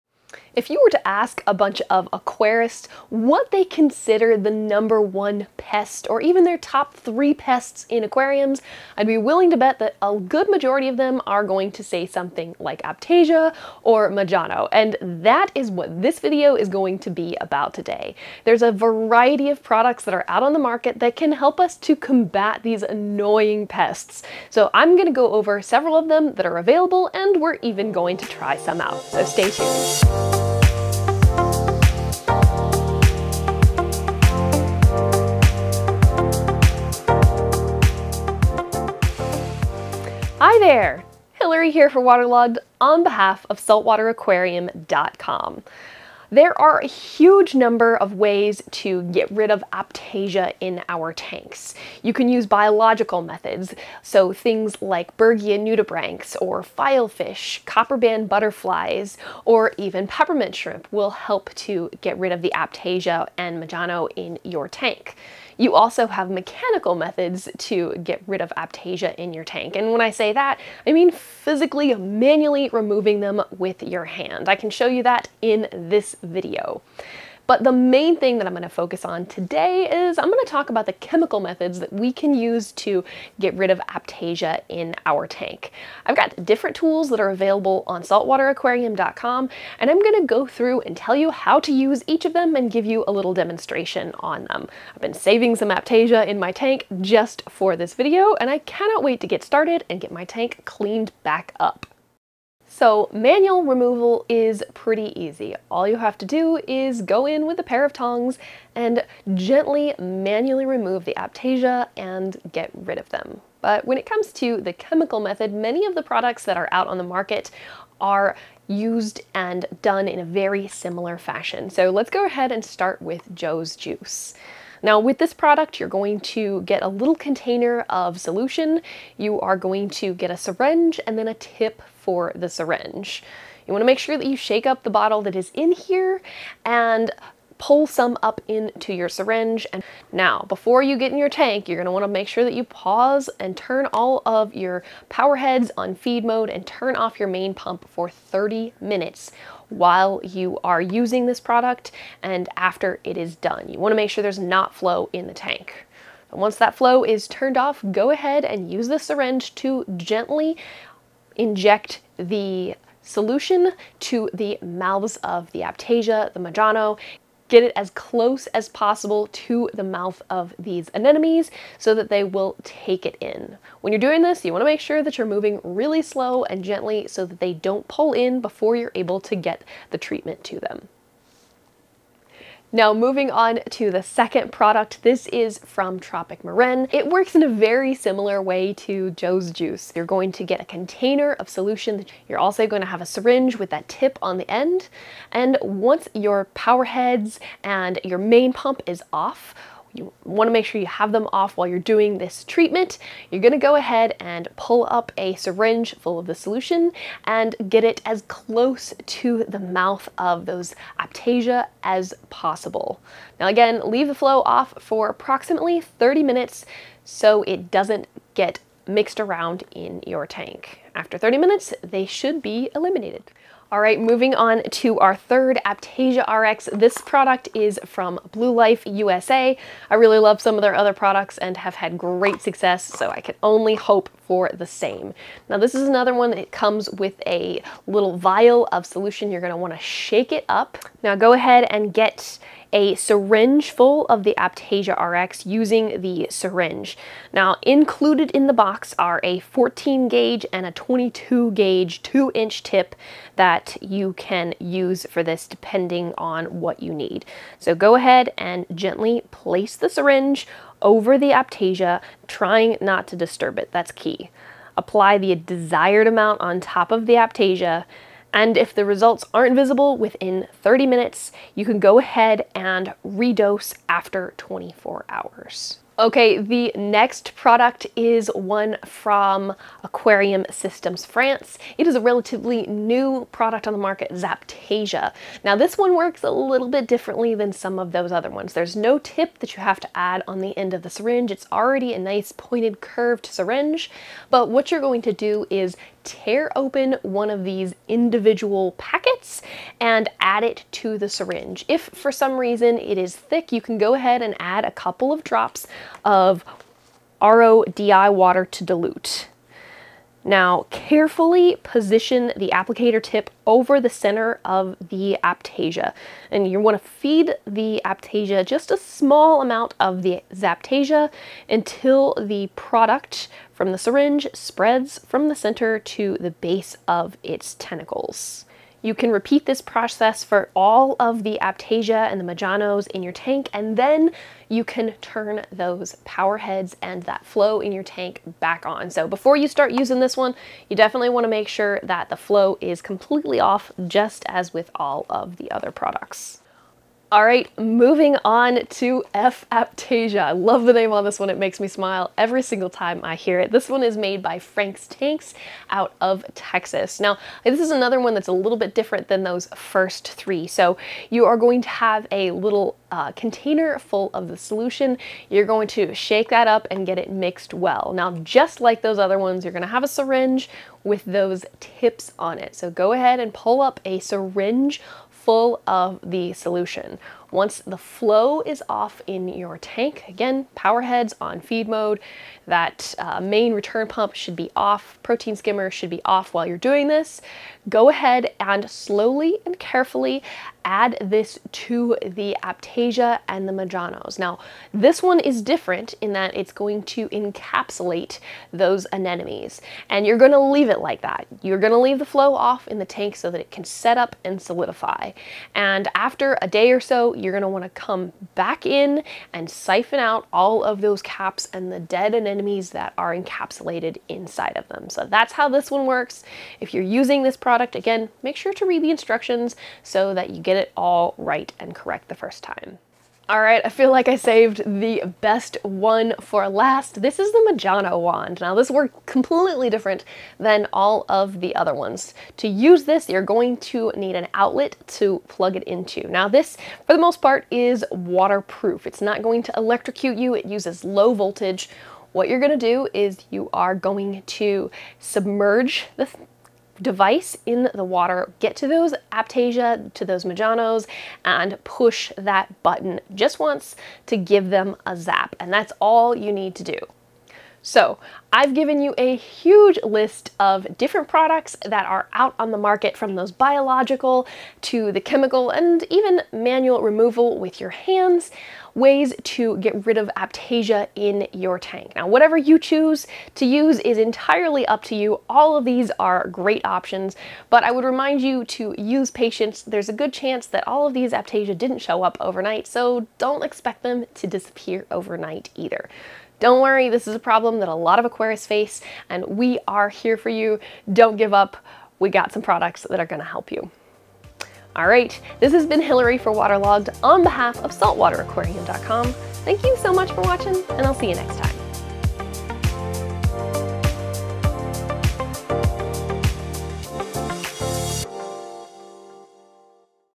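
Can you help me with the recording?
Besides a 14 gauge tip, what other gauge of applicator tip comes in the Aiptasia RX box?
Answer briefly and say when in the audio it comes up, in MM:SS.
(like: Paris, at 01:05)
22 gauge, at 04:10.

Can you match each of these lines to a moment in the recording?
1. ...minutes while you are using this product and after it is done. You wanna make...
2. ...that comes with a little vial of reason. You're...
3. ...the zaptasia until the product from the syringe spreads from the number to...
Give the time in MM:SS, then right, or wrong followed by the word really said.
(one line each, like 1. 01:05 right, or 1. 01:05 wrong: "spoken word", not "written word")
1. 02:28 right
2. 03:56 wrong: "solution", not "reason"
3. 05:20 wrong: "center", not "number".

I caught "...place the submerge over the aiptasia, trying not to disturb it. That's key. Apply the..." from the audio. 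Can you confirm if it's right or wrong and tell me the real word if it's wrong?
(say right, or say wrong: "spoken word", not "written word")
wrong: "syringe", not "submerge".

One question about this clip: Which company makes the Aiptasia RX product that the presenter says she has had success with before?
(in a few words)
Blue Life USA.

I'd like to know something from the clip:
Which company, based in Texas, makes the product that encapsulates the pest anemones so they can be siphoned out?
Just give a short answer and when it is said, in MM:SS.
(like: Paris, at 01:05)
Frank's Tanks, at 05:54.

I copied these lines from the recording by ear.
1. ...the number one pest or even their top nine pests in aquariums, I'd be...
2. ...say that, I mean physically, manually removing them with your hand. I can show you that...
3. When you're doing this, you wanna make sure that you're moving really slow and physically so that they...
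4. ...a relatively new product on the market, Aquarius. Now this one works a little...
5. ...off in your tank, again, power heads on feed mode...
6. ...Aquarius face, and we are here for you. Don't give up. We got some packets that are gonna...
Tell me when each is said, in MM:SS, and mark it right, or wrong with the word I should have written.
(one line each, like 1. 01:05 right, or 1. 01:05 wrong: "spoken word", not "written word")
1. 00:04 wrong: "three", not "nine"
2. 01:10 right
3. 02:53 wrong: "gently", not "physically"
4. 04:41 wrong: "Zaptasia", not "Aquarius"
5. 06:18 right
6. 08:08 wrong: "products", not "packets".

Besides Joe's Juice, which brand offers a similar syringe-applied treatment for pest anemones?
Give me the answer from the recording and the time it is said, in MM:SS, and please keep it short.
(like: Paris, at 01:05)
Tropic Marin, at 03:05.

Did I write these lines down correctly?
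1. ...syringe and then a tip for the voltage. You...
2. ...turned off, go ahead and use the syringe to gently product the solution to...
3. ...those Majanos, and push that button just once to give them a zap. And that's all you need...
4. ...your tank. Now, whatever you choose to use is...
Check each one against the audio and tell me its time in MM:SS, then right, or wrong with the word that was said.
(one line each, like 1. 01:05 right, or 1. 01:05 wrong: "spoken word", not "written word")
1. 02:10 wrong: "syringe", not "voltage"
2. 02:37 wrong: "inject", not "product"
3. 07:30 right
4. 07:51 right.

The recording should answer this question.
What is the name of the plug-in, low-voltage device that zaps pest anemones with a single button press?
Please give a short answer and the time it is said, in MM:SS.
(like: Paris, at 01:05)
Majano wand, at 07:07.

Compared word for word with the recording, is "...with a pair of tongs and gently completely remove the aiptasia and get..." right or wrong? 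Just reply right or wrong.
wrong.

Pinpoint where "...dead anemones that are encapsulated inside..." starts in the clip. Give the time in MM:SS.
06:51.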